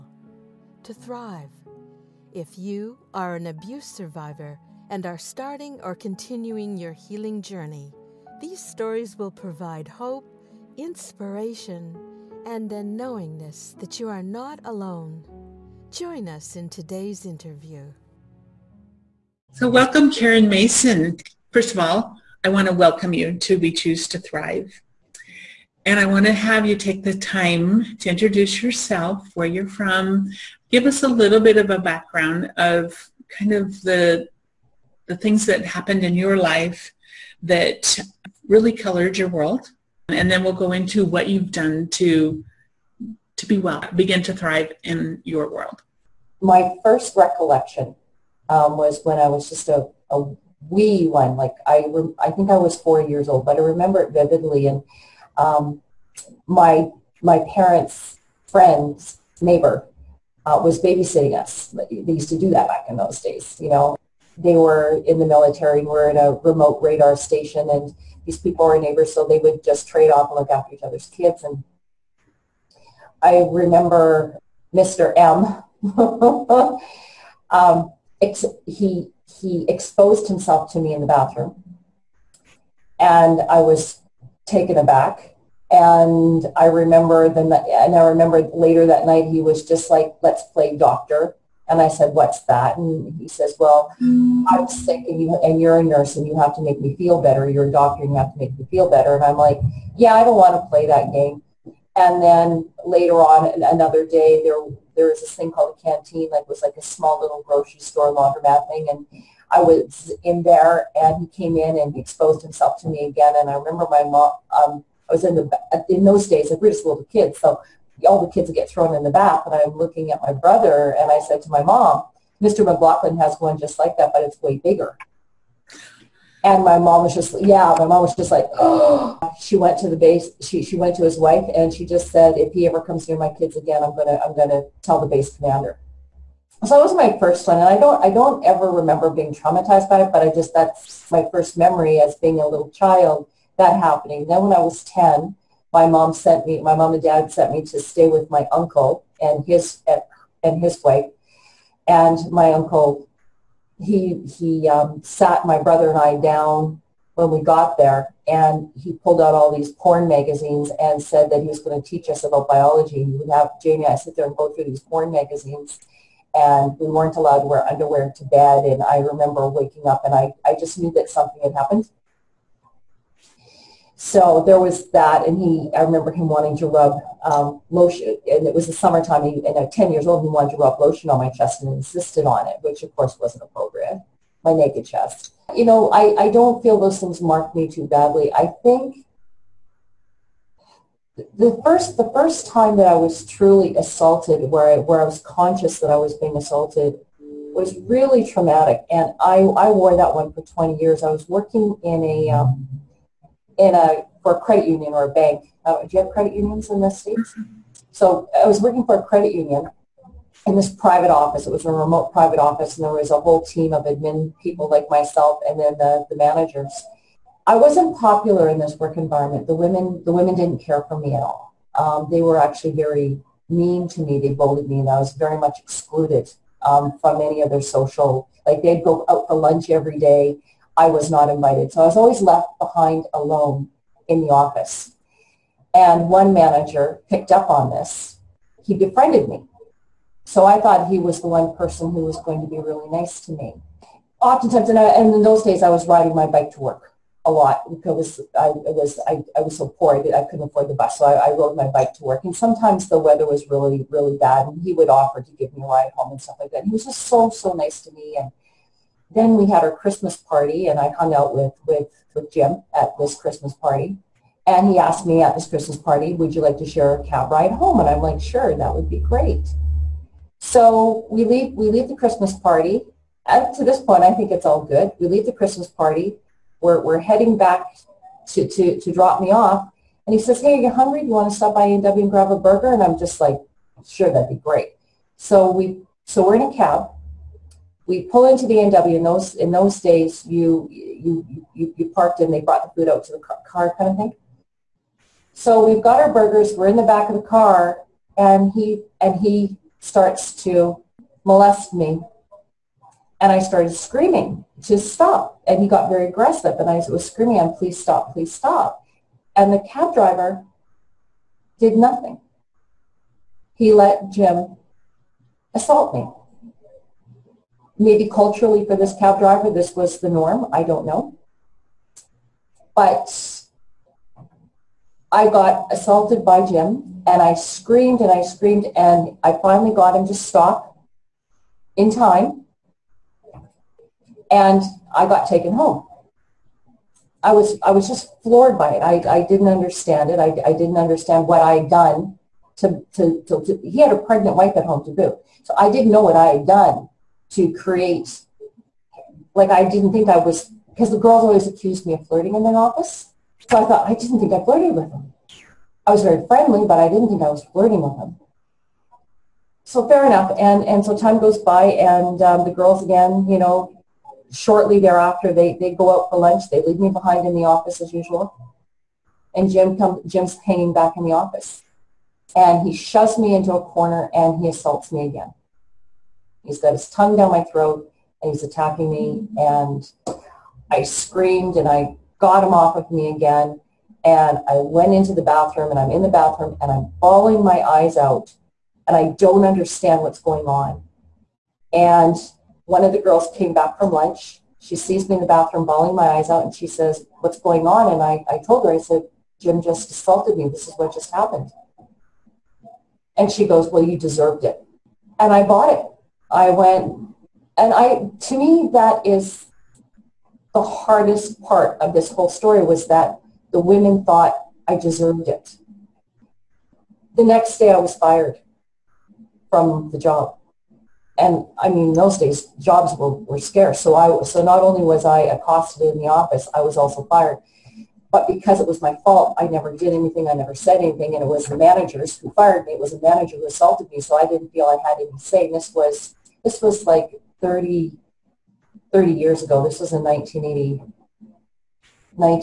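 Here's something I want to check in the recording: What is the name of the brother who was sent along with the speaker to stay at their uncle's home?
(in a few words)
Jamie.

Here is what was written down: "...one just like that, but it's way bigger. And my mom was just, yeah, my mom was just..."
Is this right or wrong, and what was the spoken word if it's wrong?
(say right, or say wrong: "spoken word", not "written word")
right.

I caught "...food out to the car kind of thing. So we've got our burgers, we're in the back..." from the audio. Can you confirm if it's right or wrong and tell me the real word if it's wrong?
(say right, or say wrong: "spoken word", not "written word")
right.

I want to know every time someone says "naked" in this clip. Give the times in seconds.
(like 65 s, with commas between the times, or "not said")
184 s.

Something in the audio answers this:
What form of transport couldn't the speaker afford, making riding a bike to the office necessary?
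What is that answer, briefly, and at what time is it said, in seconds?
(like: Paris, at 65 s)
the bus, at 250 s.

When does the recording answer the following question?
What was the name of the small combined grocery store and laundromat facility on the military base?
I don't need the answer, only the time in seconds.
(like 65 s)
105 s.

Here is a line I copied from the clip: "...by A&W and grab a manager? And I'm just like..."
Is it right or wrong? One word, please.
wrong.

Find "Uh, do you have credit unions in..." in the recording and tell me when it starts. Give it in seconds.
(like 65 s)
205 s.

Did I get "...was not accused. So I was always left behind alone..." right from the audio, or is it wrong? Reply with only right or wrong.
wrong.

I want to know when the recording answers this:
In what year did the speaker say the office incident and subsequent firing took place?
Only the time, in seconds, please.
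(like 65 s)
440 s.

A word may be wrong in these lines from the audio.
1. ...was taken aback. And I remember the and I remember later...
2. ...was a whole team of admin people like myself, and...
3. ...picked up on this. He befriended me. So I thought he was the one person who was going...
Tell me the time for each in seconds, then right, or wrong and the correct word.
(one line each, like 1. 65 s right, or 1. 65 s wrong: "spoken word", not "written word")
1. 83 s right
2. 212 s right
3. 237 s right.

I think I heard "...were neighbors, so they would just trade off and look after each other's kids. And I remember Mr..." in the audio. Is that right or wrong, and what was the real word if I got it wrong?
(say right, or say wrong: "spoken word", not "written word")
right.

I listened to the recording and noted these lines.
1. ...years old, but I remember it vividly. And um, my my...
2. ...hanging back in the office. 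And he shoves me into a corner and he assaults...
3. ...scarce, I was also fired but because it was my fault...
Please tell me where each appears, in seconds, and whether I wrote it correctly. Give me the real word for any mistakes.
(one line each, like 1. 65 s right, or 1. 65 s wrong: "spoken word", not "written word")
1. 53 s right
2. 370 s right
3. 426 s wrong: "office", not "scarce".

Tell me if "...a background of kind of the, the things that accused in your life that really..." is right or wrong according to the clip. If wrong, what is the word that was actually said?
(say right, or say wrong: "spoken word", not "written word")
wrong: "happened", not "accused".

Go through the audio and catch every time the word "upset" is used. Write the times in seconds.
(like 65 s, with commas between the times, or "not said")
not said.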